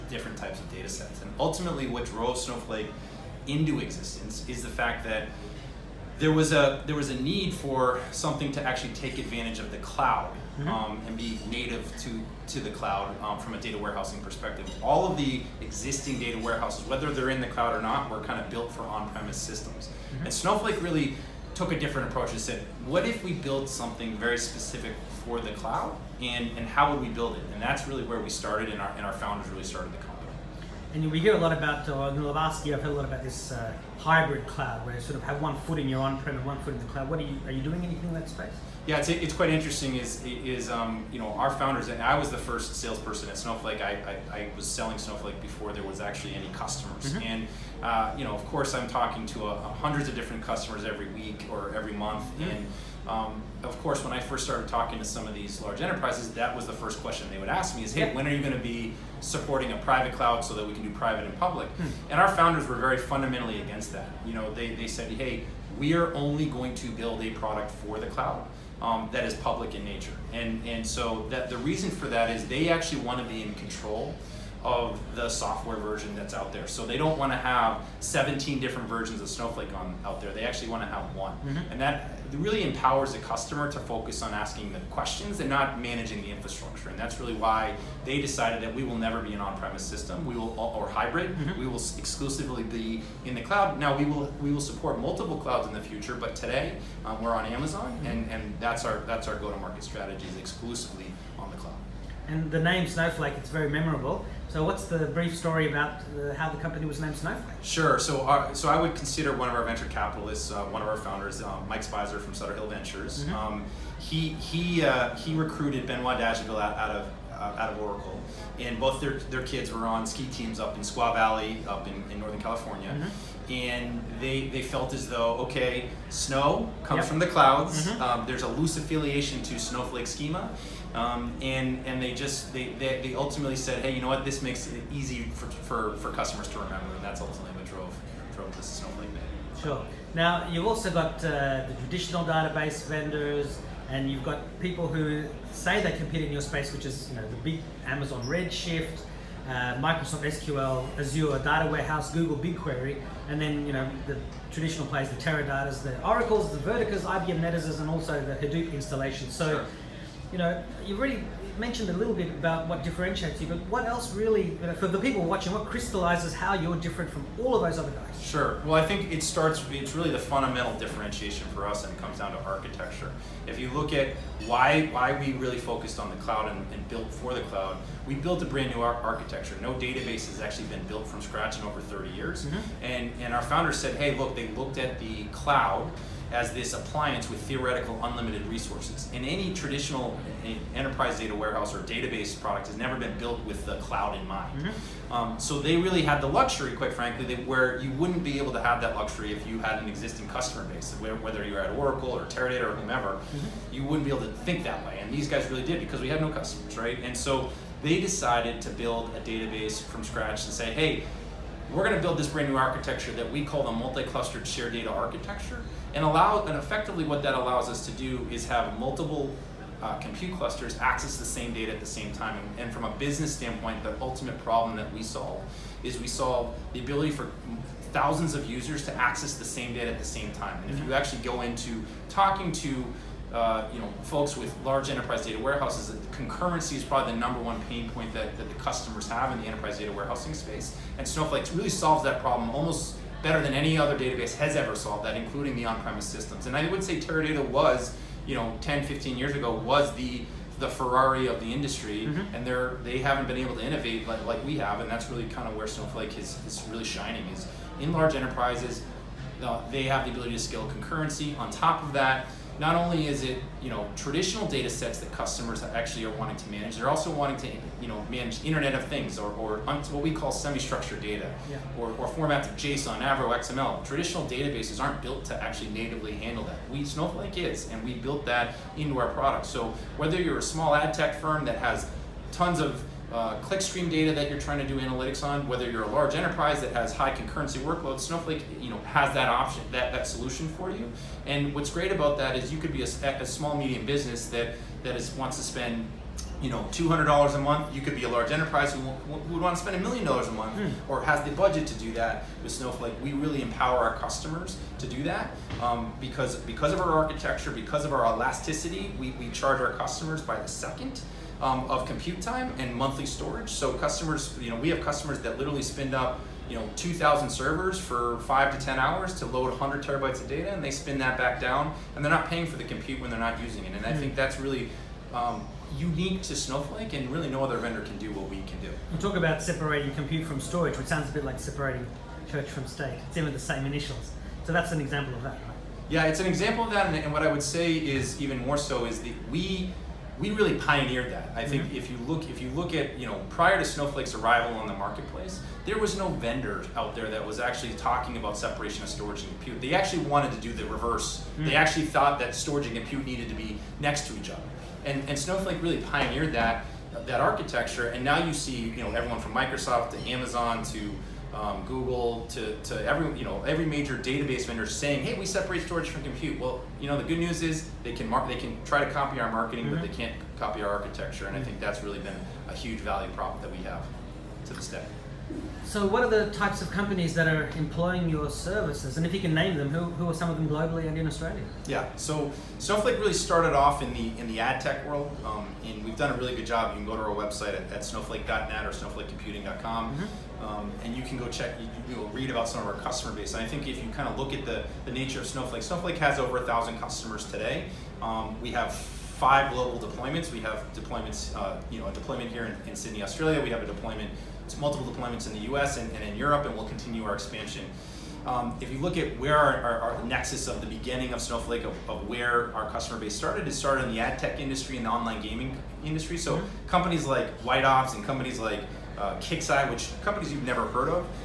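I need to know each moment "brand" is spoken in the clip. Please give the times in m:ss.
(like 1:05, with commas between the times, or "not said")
2:58, 3:32.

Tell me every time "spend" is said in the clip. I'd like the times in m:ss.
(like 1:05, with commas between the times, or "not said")
4:55, 4:59, 5:15.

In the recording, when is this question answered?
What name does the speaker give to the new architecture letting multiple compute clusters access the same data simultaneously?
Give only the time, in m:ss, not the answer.
3:33.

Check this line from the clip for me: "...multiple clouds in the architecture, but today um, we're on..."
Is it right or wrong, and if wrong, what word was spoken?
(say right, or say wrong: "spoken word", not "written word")
wrong: "future", not "architecture".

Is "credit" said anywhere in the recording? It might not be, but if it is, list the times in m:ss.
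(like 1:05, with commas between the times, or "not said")
not said.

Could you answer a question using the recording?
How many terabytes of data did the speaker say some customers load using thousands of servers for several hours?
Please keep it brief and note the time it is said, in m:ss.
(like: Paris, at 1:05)
100 terabytes, at 5:19.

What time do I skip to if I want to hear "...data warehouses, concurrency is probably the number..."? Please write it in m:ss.
3:55.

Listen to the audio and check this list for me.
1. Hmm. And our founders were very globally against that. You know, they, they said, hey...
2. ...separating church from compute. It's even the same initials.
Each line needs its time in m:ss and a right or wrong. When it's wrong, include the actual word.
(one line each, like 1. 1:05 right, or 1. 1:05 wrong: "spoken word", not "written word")
1. 1:01 wrong: "fundamentally", not "globally"
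2. 5:31 wrong: "state", not "compute".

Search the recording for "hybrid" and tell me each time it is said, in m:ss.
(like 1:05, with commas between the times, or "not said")
0:33, 1:30.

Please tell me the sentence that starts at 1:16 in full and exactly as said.
So they don't want to have 17 different versions of Snowflake on out there.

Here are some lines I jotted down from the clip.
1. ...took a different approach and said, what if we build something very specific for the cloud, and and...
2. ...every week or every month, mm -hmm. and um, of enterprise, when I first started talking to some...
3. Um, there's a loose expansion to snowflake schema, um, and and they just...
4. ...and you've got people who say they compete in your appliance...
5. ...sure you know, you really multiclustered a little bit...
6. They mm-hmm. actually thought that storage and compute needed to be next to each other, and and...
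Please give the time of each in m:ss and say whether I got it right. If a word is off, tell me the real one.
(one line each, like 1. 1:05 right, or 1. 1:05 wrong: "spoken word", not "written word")
1. 0:21 right
2. 0:50 wrong: "course", not "enterprise"
3. 2:08 wrong: "affiliation", not "expansion"
4. 2:23 wrong: "space", not "appliance"
5. 2:39 wrong: "mentioned", not "multiclustered"
6. 5:51 right.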